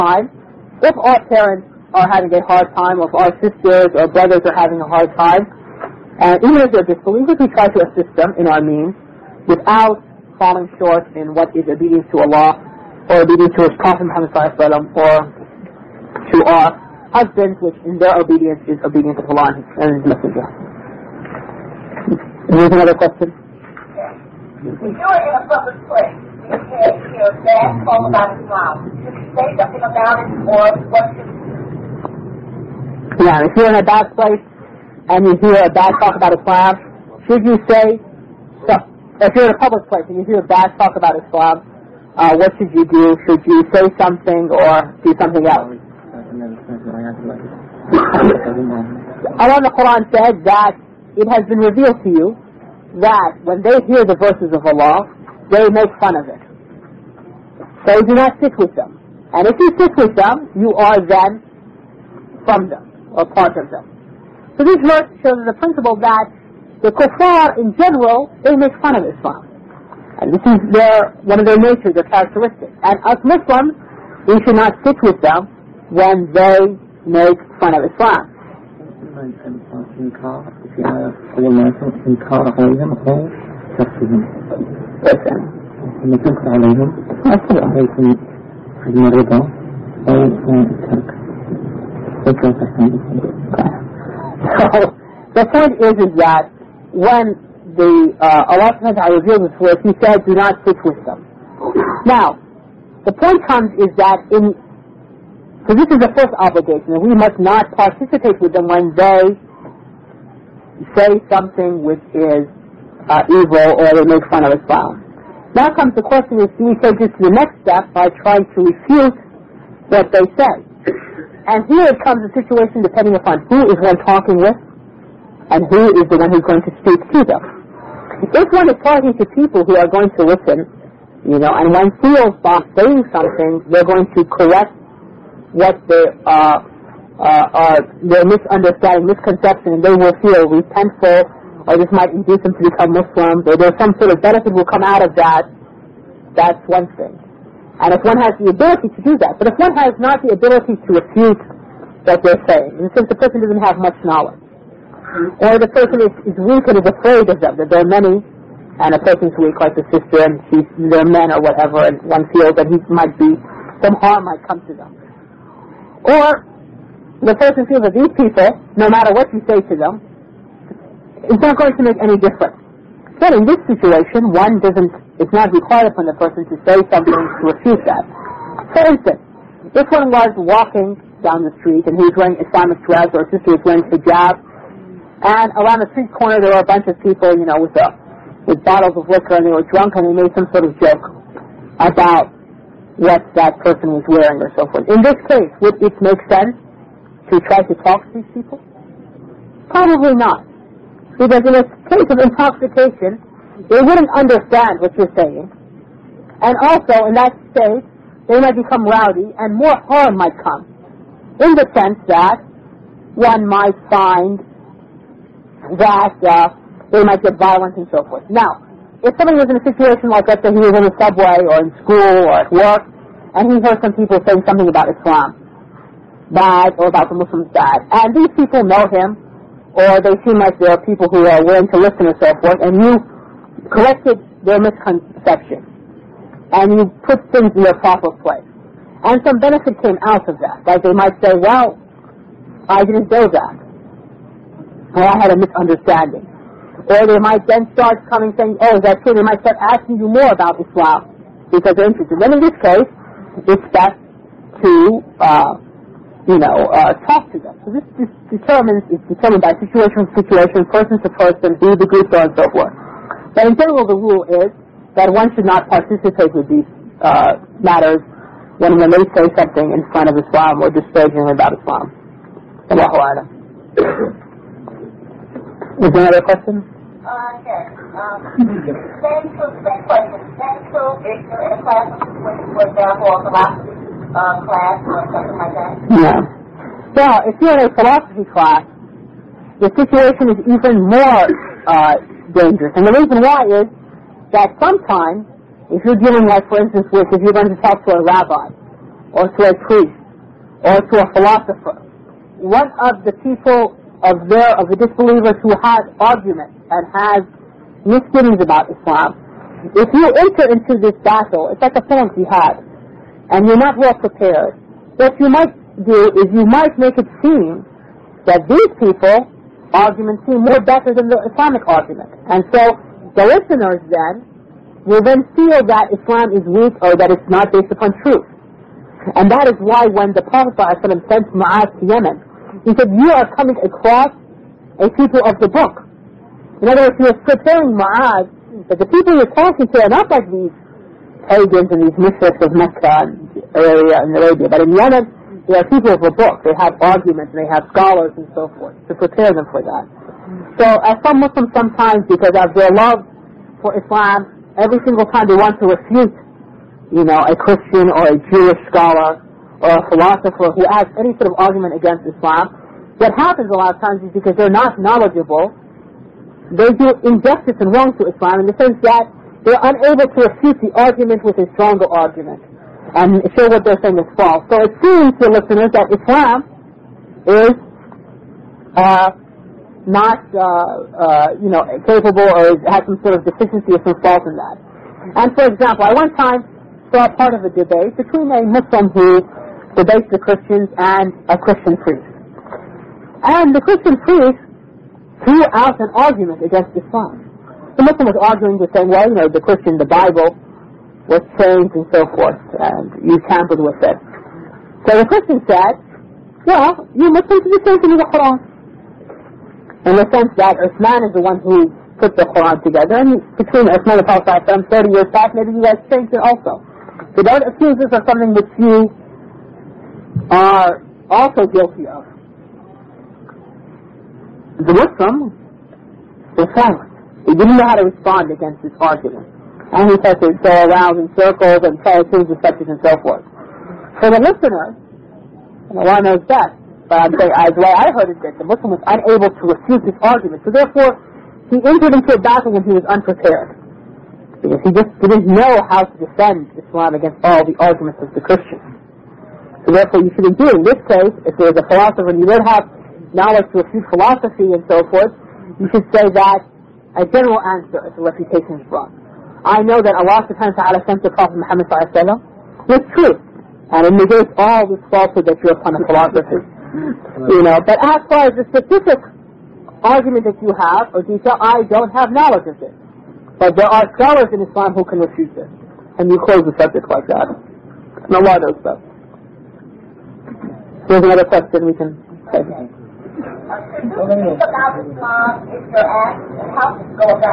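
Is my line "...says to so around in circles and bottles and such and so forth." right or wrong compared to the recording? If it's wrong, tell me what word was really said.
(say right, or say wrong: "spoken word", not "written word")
wrong: "tries", not "bottles".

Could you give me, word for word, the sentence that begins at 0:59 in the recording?
And if you sit with them, you are then from them or part of them.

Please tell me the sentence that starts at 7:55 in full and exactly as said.
And you close the subject like that.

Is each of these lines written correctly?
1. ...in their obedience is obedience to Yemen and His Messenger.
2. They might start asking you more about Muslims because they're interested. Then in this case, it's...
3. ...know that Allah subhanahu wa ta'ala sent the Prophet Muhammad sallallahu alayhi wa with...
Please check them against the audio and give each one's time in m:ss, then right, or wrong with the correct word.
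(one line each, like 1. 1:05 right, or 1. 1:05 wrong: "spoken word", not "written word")
1. 0:17 wrong: "Allah", not "Yemen"
2. 4:09 wrong: "Islam", not "Muslims"
3. 7:39 right.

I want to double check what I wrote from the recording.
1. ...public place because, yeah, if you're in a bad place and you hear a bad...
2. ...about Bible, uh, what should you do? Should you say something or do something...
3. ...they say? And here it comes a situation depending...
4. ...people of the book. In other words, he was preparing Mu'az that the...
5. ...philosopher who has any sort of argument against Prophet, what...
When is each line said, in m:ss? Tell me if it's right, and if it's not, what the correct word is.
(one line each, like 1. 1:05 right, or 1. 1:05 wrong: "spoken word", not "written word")
1. 0:25 right
2. 0:40 wrong: "Islam", not "Bible"
3. 2:00 right
4. 5:34 right
5. 5:59 wrong: "Islam", not "Prophet".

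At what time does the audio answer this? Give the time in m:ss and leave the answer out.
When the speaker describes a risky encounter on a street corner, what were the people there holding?
3:08.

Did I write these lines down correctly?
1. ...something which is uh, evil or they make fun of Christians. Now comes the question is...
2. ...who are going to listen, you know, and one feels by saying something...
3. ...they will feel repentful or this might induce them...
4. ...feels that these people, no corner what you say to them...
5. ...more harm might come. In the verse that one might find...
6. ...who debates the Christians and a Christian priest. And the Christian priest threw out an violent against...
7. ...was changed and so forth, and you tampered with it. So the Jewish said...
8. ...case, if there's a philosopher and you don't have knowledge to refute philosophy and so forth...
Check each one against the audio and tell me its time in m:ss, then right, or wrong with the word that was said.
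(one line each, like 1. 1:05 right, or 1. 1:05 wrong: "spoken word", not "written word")
1. 1:51 wrong: "Islam", not "Christians"
2. 2:09 right
3. 2:19 right
4. 2:47 wrong: "matter", not "corner"
5. 3:29 wrong: "sense", not "verse"
6. 6:28 wrong: "argument", not "violent"
7. 6:41 wrong: "Christian", not "Jewish"
8. 7:30 right.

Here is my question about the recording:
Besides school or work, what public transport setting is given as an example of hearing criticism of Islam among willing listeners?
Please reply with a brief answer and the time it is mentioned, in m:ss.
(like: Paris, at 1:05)
subway, at 3:40.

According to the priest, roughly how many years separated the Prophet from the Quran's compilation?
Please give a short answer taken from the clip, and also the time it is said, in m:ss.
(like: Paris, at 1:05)
30 years, at 6:54.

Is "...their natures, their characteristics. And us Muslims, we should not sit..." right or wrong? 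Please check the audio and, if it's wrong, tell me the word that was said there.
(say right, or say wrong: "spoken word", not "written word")
right.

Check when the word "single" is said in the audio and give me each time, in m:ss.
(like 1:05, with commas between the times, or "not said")
5:54.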